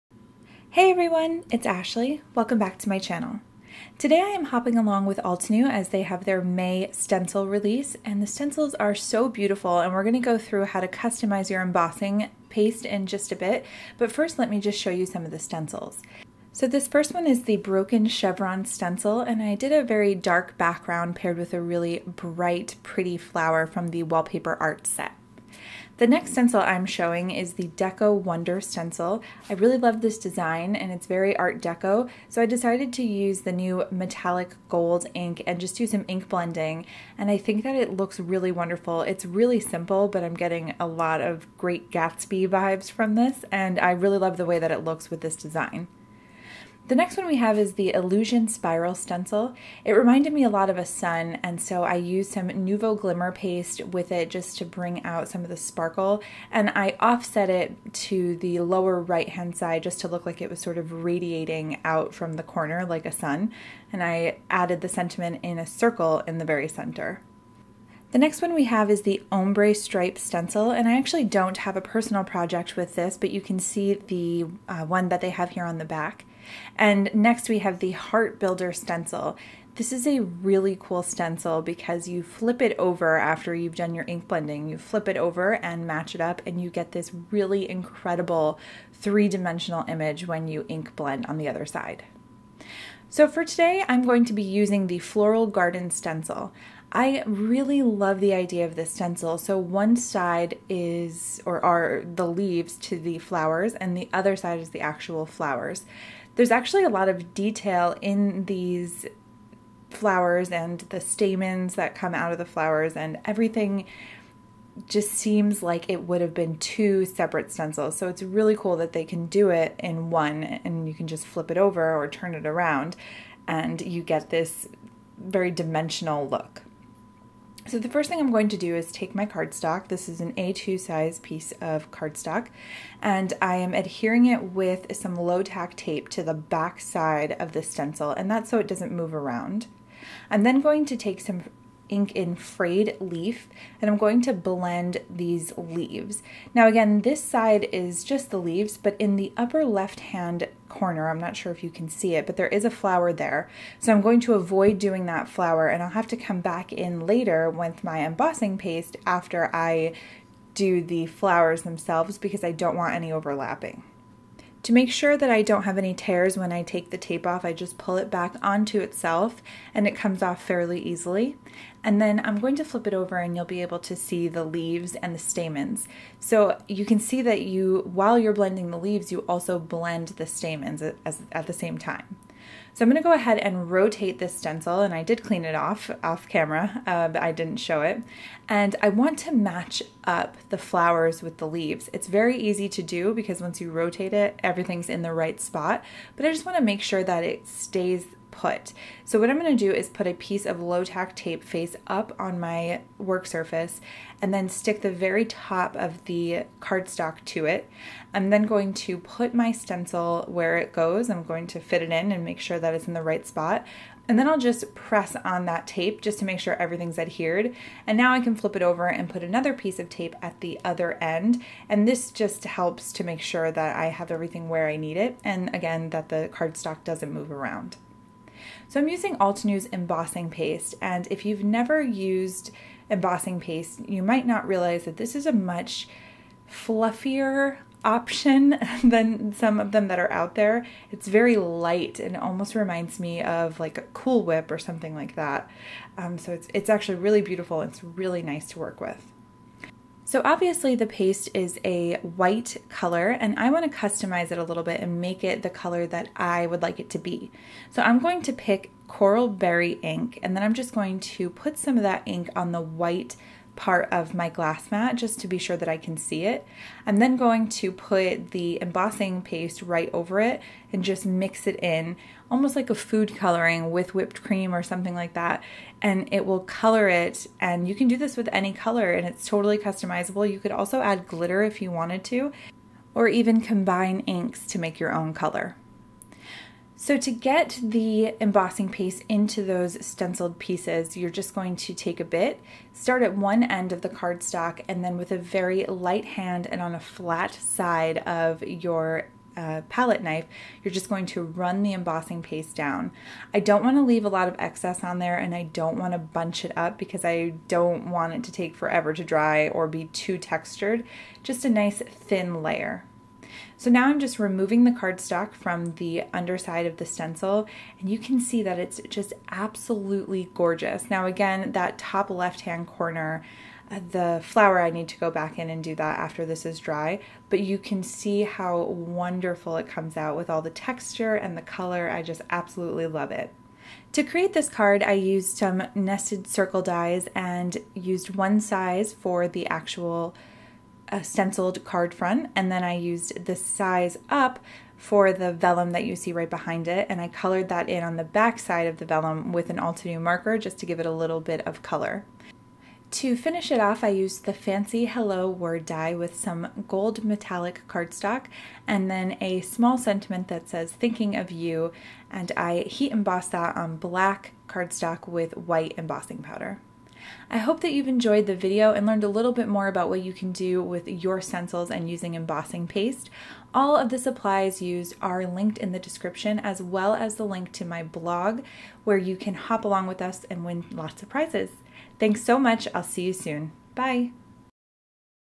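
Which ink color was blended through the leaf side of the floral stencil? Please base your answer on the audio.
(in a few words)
Frayed Leaf.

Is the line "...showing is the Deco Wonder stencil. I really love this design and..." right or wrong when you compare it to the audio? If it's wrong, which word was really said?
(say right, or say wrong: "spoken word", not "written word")
right.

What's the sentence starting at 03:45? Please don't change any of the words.
And again, that the cardstock doesn't move around.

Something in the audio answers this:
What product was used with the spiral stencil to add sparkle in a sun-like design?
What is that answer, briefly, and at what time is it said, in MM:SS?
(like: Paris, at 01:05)
Nuvo Glimmer Paste, at 00:52.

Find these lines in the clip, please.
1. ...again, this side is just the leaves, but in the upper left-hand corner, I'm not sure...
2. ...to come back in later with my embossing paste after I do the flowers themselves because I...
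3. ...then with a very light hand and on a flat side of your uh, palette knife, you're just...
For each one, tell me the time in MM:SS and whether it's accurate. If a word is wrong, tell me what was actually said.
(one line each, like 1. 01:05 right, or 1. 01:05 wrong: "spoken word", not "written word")
1. 02:26 right
2. 02:36 right
3. 04:54 right.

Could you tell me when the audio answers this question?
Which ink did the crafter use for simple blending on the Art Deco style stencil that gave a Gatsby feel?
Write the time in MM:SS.
00:33.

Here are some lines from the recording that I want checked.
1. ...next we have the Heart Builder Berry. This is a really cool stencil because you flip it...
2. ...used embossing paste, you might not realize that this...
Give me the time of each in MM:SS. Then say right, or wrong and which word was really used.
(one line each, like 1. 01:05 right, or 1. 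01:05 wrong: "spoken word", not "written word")
1. 01:17 wrong: "Stencil", not "Berry"
2. 03:51 right.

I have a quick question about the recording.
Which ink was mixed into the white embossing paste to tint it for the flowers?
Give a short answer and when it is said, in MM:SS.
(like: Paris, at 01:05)
Coral Berry, at 04:18.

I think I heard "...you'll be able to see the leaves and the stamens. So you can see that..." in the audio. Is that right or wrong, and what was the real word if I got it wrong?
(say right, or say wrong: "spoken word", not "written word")
right.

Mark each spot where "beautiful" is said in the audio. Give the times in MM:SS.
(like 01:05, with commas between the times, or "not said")
00:09, 04:07.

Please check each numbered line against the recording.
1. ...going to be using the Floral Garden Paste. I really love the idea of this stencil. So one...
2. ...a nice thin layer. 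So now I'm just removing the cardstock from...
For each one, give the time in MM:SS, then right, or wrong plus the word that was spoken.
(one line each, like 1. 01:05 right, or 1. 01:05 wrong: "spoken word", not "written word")
1. 01:34 wrong: "Stencil", not "Paste"
2. 05:11 right.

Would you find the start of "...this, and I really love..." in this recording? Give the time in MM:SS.
00:43.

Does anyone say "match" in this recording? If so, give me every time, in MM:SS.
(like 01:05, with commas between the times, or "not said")
01:25, 03:09.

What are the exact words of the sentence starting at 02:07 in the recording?
So the first thing I'm going to do is take my cardstock.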